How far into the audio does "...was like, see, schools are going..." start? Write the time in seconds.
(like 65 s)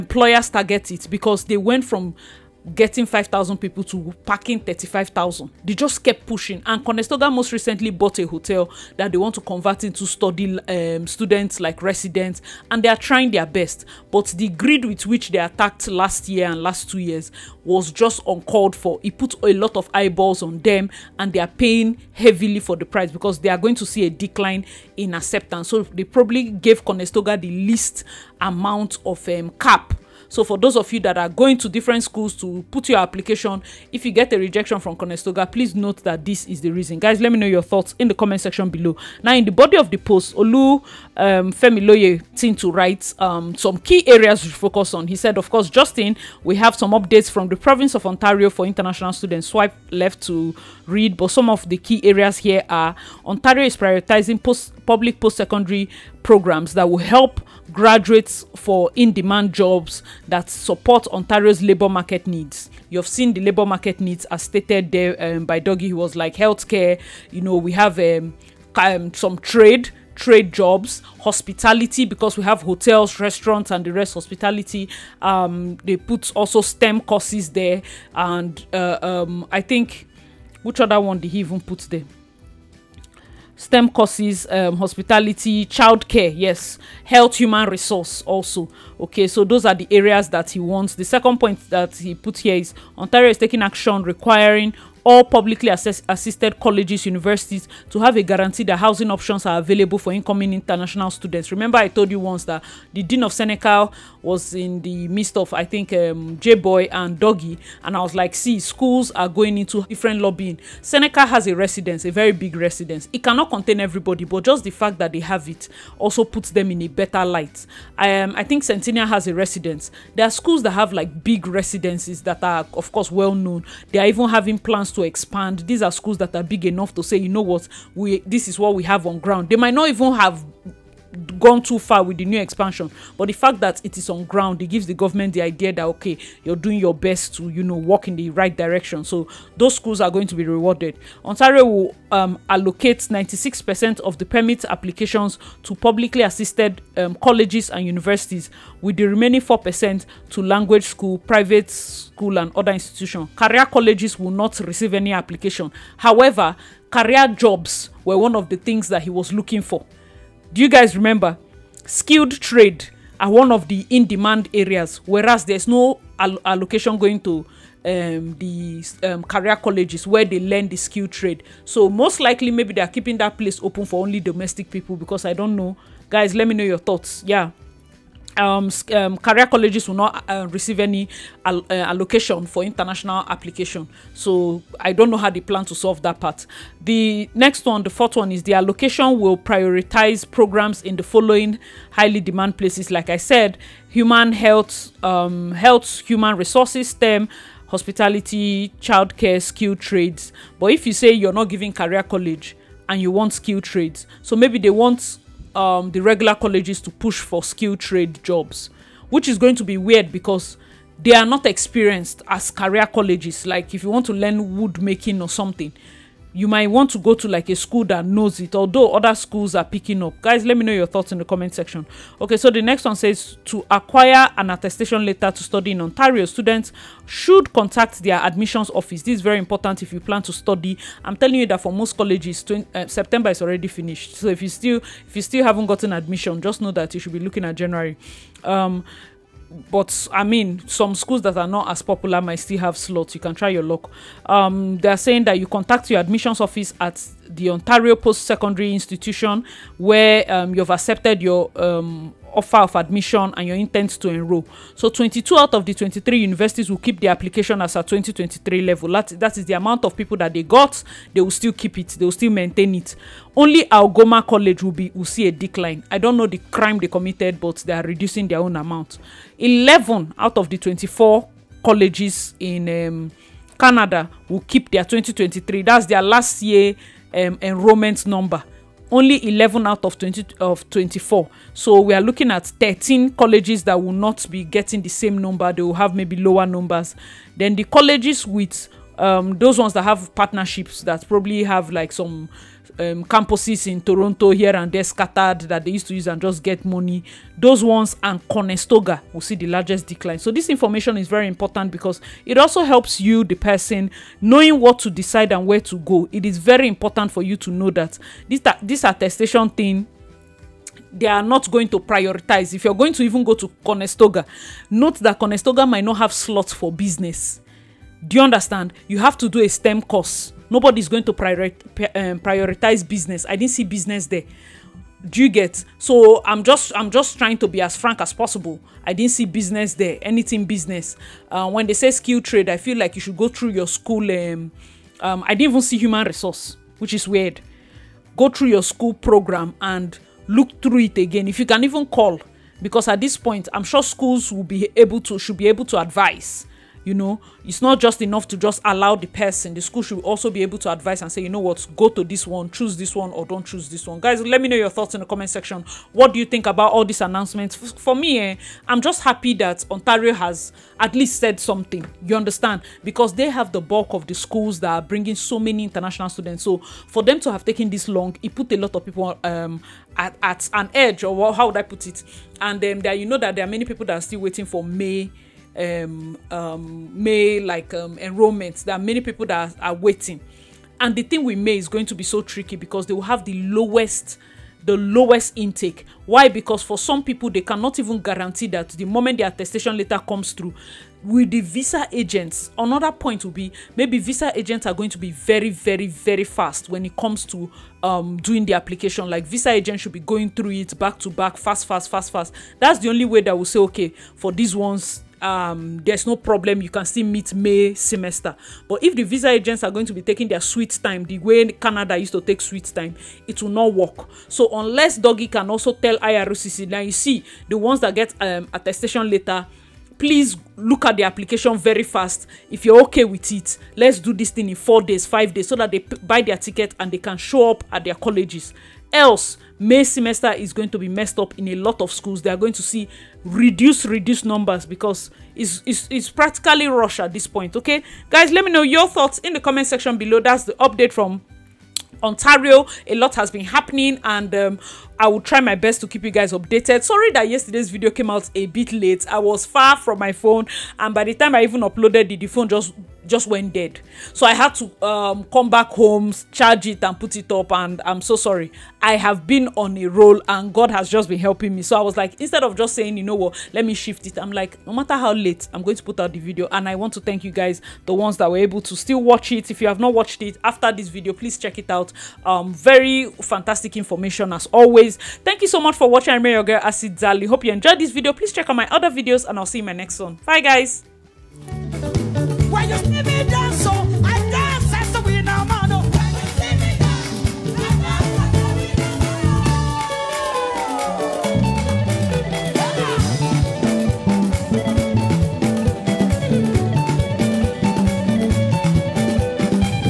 108 s.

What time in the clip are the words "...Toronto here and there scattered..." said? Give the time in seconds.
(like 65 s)
293 s.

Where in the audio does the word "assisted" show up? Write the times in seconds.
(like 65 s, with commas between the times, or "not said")
96 s, 146 s.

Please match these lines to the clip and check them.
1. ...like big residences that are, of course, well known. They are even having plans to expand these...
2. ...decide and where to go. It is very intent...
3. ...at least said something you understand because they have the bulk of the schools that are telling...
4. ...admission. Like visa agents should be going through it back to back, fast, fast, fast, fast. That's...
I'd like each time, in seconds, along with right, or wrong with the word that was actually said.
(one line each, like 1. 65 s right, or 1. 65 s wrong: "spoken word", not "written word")
1. 120 s right
2. 304 s wrong: "important", not "intent"
3. 360 s wrong: "bringing", not "telling"
4. 398 s wrong: "application", not "admission".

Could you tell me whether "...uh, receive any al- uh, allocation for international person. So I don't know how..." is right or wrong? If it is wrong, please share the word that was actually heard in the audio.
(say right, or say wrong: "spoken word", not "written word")
wrong: "application", not "person".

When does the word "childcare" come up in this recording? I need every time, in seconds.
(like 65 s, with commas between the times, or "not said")
85 s, 198 s.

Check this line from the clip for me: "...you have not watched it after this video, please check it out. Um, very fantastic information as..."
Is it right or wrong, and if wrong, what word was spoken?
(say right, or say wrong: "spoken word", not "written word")
right.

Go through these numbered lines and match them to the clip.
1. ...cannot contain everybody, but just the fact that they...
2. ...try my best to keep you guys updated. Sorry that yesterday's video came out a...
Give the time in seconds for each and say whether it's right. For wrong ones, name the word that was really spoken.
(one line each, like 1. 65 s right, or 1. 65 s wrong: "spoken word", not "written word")
1. 113 s right
2. 445 s right.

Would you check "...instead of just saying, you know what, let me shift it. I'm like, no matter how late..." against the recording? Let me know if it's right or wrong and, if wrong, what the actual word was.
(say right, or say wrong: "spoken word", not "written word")
right.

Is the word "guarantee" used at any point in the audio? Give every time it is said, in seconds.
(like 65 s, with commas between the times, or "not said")
98 s, 387 s.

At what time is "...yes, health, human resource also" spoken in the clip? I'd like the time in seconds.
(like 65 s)
86 s.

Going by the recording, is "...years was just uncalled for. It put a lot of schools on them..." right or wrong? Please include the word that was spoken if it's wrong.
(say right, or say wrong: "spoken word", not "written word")
wrong: "eyeballs", not "schools".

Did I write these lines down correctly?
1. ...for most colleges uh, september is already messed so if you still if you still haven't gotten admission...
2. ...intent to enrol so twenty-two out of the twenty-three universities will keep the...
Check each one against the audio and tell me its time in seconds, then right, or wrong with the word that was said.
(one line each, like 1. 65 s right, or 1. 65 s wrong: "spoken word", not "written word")
1. 231 s wrong: "finished", not "messed"
2. 253 s right.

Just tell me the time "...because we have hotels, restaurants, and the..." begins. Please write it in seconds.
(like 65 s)
72 s.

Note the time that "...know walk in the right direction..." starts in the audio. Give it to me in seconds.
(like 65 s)
137 s.